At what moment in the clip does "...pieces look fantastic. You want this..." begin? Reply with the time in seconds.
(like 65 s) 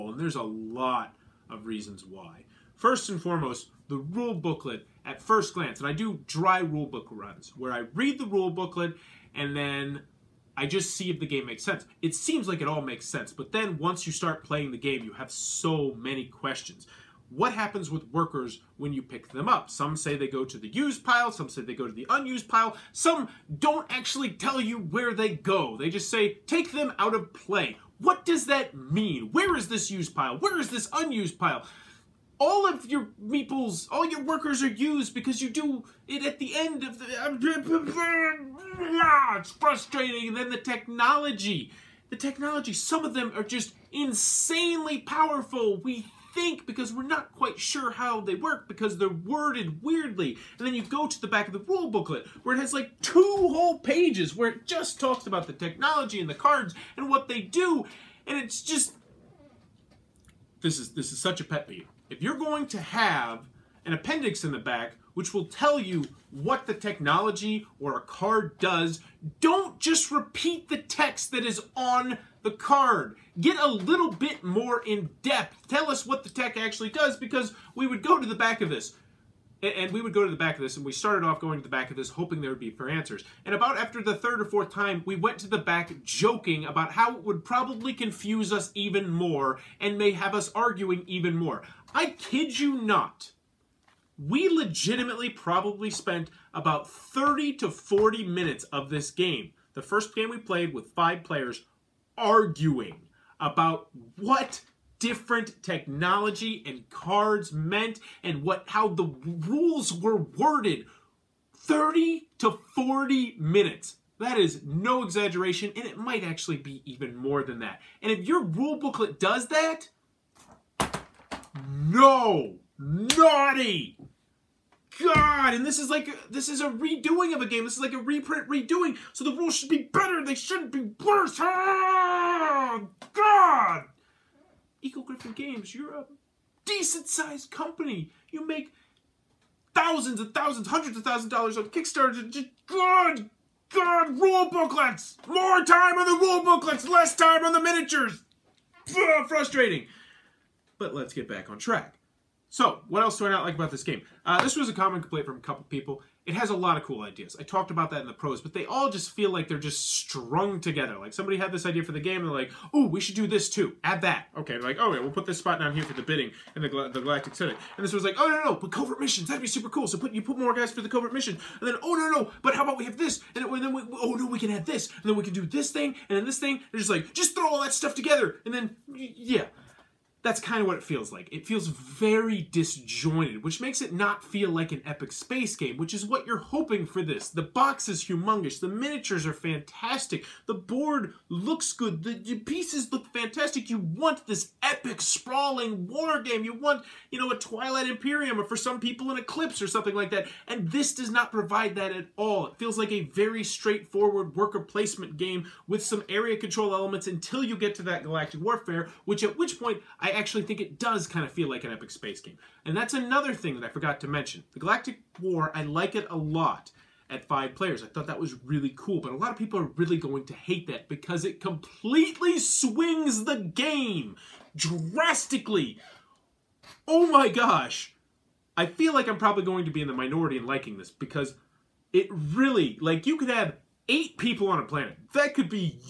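192 s.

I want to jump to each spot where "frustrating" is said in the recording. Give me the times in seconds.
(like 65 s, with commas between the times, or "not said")
39 s, 149 s.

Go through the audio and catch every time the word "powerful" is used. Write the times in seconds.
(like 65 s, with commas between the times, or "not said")
44 s.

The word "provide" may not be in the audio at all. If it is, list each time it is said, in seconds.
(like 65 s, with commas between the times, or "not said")
201 s.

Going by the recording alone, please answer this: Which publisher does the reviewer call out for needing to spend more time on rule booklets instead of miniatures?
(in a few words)
Eagle Gryphon Games.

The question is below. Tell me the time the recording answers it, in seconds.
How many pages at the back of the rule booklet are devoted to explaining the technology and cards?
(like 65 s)
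53 s.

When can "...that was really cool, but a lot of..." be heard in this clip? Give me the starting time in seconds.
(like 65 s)
218 s.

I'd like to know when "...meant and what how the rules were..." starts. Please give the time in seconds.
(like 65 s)
107 s.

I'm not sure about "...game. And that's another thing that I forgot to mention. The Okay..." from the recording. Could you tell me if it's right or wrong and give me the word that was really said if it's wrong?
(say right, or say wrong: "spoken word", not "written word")
wrong: "Galactic", not "Okay".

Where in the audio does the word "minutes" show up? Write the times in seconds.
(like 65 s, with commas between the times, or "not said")
98 s, 113 s.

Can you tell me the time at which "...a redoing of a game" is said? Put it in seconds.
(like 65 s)
126 s.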